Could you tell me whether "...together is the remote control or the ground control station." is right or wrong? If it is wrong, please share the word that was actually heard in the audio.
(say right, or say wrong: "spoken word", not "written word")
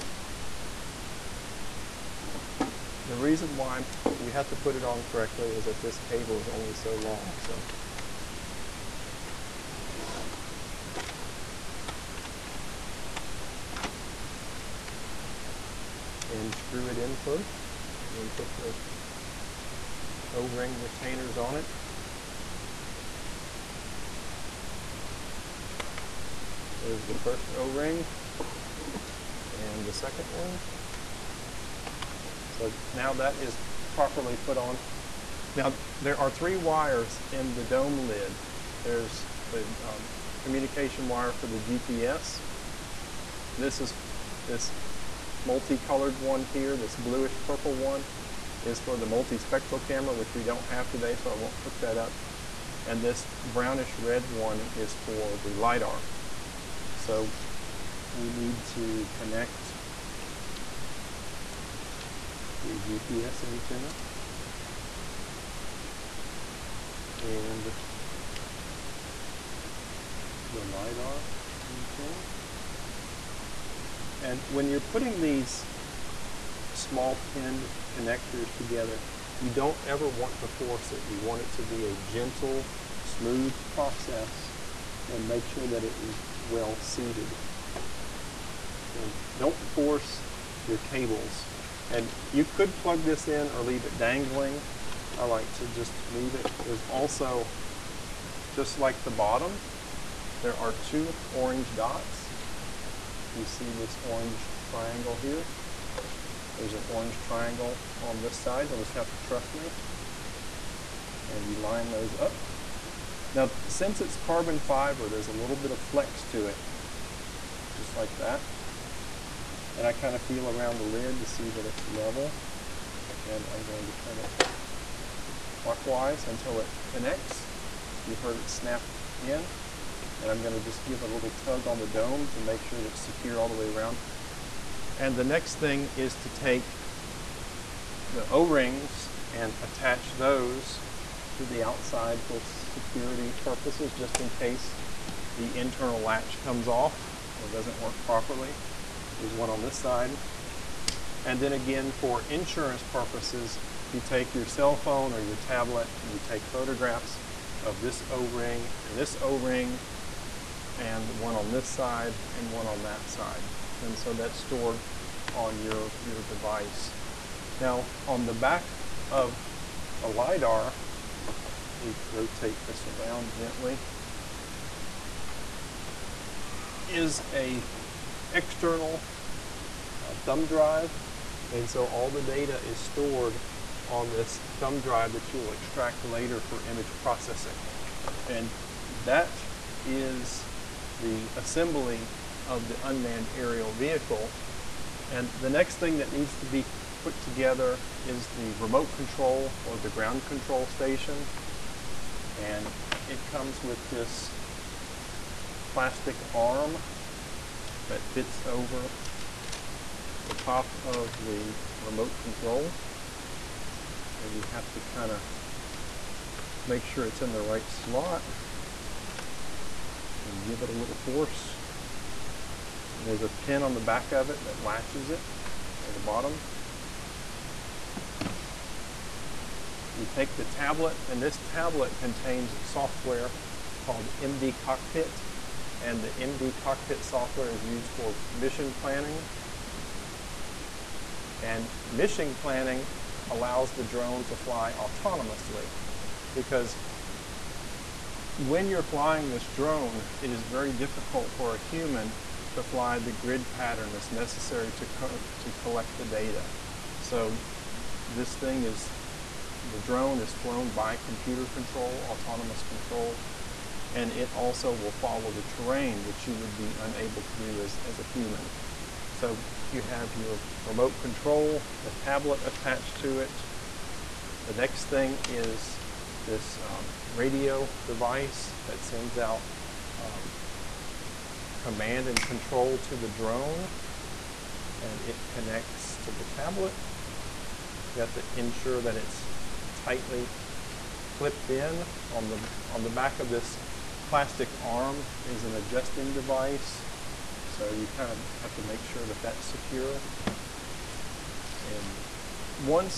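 right.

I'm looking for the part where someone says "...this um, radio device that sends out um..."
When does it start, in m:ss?
4:36.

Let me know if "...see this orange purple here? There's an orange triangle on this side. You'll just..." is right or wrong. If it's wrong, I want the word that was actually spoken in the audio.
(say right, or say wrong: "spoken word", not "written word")
wrong: "triangle", not "purple".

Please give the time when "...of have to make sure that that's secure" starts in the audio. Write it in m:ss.
4:58.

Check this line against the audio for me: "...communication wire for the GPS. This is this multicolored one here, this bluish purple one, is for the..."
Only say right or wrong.
right.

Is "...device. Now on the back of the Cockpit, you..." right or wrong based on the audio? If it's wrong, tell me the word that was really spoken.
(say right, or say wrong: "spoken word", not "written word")
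wrong: "LiDAR", not "Cockpit".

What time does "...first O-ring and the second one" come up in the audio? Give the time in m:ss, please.
0:27.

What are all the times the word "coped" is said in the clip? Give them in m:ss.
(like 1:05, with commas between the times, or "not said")
not said.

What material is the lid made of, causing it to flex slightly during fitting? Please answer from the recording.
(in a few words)
Carbon fiber.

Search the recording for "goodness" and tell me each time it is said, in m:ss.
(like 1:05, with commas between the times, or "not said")
not said.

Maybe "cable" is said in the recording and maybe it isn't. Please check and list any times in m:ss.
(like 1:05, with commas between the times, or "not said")
0:05, 1:30.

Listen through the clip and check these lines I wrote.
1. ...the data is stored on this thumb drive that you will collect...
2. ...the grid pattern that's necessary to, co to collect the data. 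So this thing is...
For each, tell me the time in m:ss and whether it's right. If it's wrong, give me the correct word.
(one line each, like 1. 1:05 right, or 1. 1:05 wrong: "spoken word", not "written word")
1. 3:02 wrong: "extract", not "collect"
2. 4:12 right.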